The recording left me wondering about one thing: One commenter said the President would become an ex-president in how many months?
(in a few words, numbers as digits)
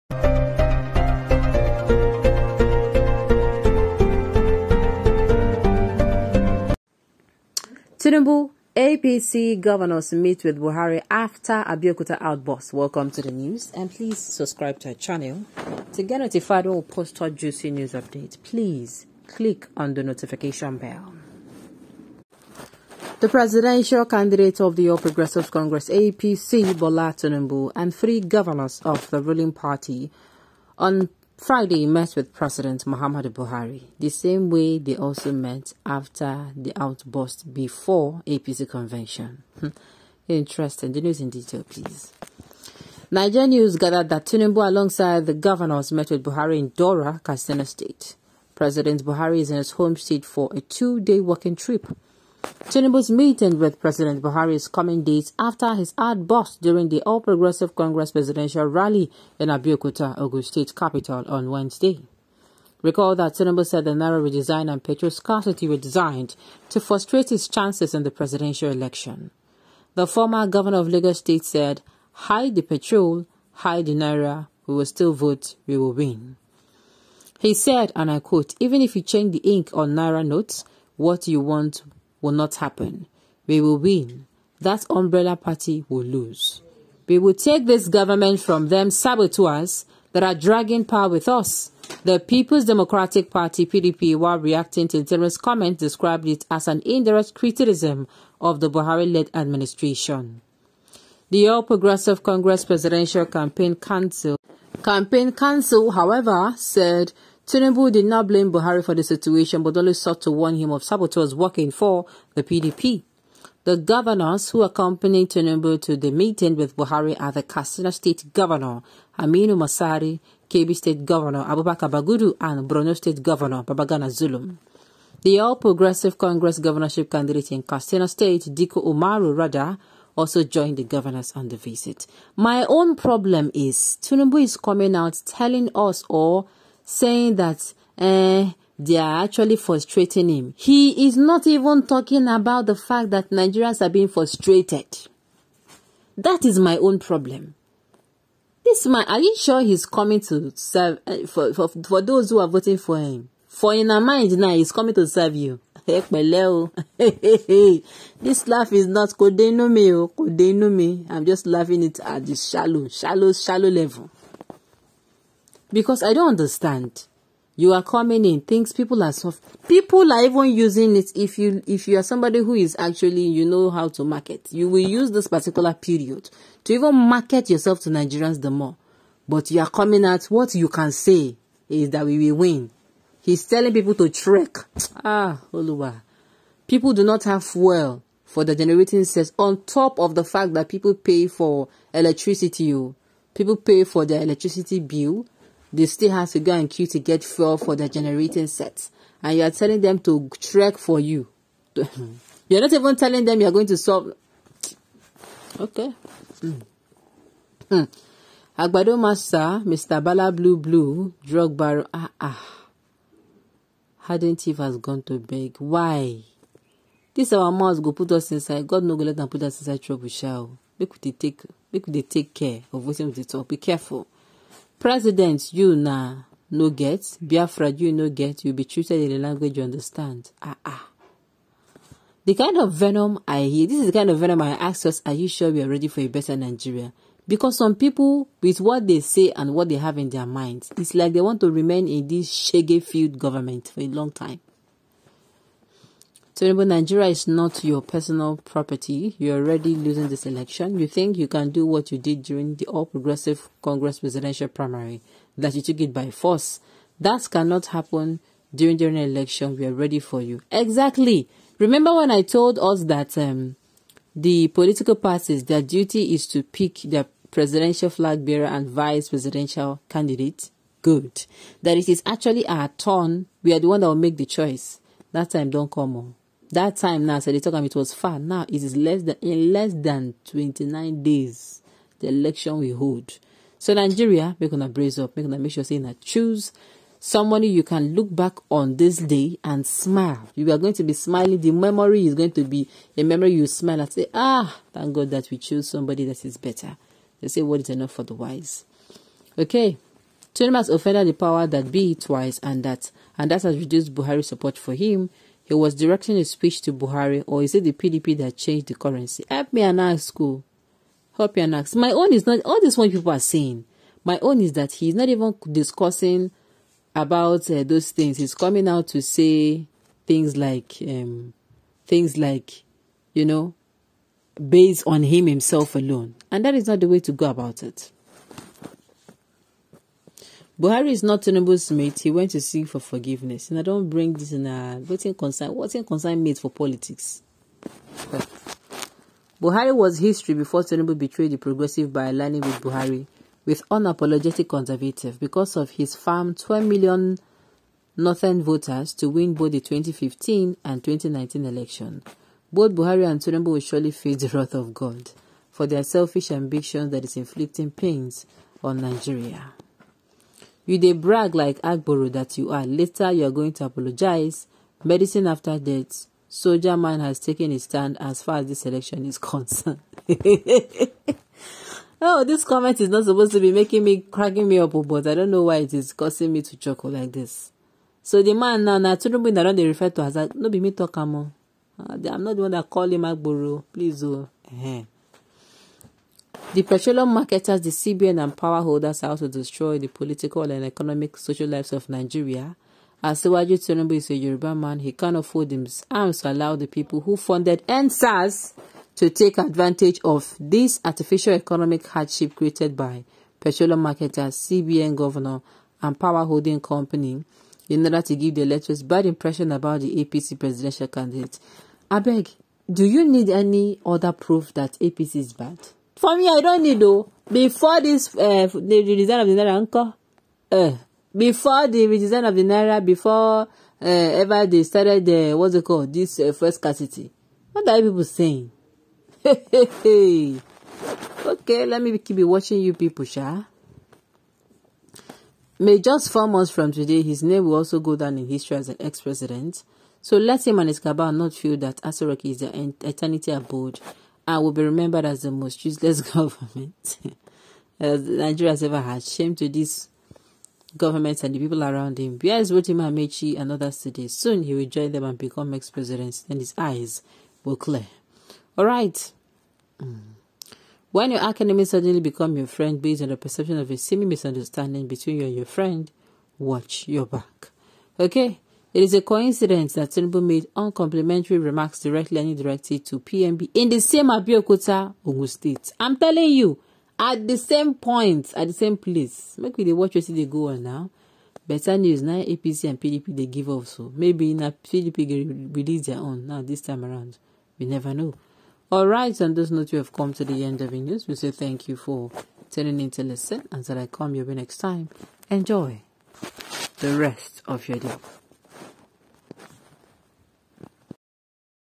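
4.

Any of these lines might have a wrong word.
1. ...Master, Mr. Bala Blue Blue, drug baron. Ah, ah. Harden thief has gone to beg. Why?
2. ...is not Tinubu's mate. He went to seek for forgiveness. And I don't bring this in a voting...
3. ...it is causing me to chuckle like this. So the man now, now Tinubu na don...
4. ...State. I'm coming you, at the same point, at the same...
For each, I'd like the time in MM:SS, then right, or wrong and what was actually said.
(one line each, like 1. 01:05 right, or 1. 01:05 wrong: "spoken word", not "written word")
1. 03:28 right
2. 05:30 right
3. 06:15 right
4. 07:55 wrong: "telling", not "coming".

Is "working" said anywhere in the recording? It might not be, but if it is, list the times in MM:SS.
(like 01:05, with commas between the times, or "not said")
00:51, 01:51.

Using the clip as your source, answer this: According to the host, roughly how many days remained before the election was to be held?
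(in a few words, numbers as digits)
29.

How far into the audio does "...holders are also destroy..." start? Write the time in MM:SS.
06:28.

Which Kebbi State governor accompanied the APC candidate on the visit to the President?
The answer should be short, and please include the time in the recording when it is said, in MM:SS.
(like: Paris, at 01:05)
Abubakar Bagudu, at 02:01.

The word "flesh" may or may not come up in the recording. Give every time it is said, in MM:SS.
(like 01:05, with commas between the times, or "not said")
not said.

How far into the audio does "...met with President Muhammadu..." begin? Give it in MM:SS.
00:31.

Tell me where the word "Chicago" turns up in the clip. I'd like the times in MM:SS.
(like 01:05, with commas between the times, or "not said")
not said.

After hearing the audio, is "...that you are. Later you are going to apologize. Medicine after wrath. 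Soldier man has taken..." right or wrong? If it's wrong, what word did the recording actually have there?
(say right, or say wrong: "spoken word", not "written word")
wrong: "death", not "wrath".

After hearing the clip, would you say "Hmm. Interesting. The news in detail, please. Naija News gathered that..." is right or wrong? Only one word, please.
right.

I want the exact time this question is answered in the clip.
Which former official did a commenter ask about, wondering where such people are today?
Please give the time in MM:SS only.
07:32.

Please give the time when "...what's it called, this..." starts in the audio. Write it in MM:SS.
07:05.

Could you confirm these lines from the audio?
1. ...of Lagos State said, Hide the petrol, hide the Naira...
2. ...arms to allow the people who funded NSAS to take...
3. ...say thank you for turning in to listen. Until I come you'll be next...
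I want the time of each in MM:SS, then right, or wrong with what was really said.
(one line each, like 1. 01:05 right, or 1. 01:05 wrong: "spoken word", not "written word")
1. 01:10 right
2. 06:35 right
3. 08:11 right.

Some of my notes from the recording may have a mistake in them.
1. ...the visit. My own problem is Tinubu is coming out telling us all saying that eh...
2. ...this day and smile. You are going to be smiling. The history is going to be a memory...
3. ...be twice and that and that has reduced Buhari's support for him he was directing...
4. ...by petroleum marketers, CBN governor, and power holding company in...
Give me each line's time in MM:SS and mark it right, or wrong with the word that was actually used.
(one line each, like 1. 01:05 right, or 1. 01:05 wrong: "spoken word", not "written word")
1. 02:11 right
2. 04:48 wrong: "memory", not "history"
3. 05:01 right
4. 06:42 right.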